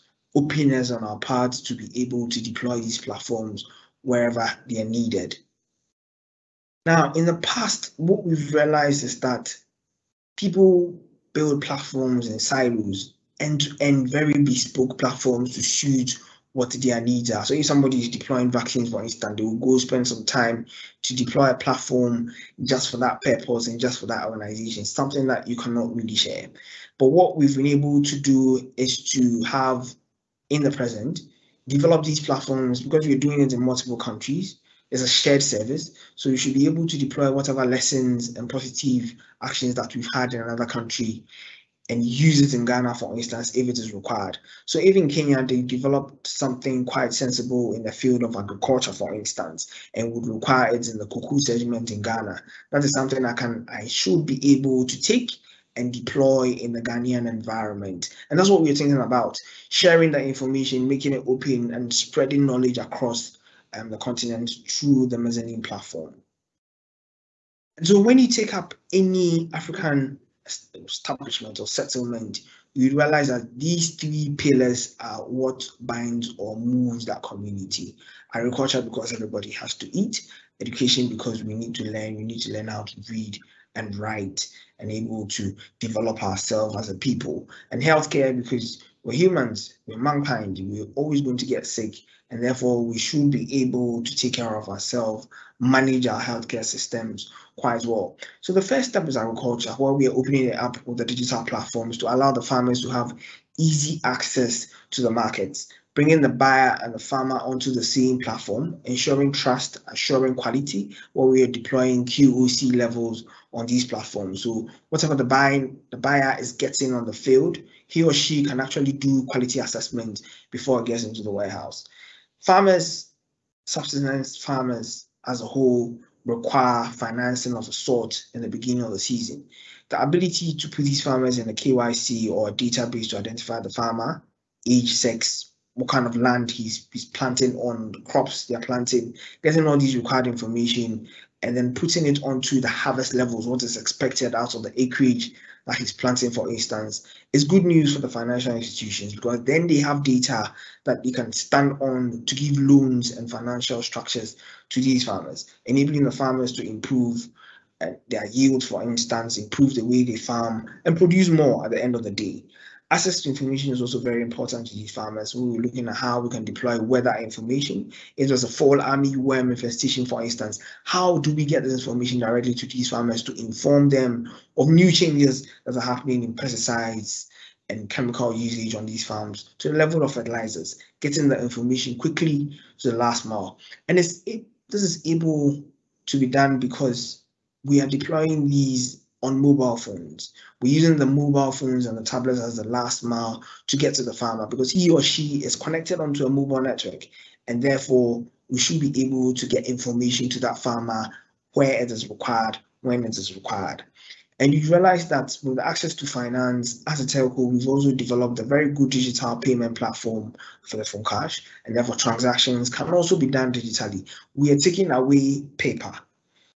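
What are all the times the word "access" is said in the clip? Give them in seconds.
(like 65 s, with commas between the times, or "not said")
104 s, 162 s, 205 s.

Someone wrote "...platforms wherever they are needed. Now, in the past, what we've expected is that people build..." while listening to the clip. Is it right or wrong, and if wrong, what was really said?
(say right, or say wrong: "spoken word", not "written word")
wrong: "realized", not "expected".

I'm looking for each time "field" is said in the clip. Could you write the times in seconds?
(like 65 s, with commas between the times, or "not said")
47 s, 117 s.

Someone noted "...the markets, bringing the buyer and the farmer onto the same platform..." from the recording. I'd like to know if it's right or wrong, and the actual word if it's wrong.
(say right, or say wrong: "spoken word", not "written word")
right.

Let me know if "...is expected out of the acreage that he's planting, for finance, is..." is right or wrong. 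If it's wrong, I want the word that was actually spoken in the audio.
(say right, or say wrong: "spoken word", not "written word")
wrong: "instance", not "finance".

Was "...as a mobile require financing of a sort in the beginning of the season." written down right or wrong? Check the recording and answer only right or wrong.
wrong.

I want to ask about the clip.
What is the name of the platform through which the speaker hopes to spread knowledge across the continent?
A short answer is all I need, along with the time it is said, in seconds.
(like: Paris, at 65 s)
mezzanine, at 65 s.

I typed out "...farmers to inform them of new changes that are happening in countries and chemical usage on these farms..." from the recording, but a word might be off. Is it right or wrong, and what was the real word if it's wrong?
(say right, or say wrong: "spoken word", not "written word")
wrong: "pesticides", not "countries".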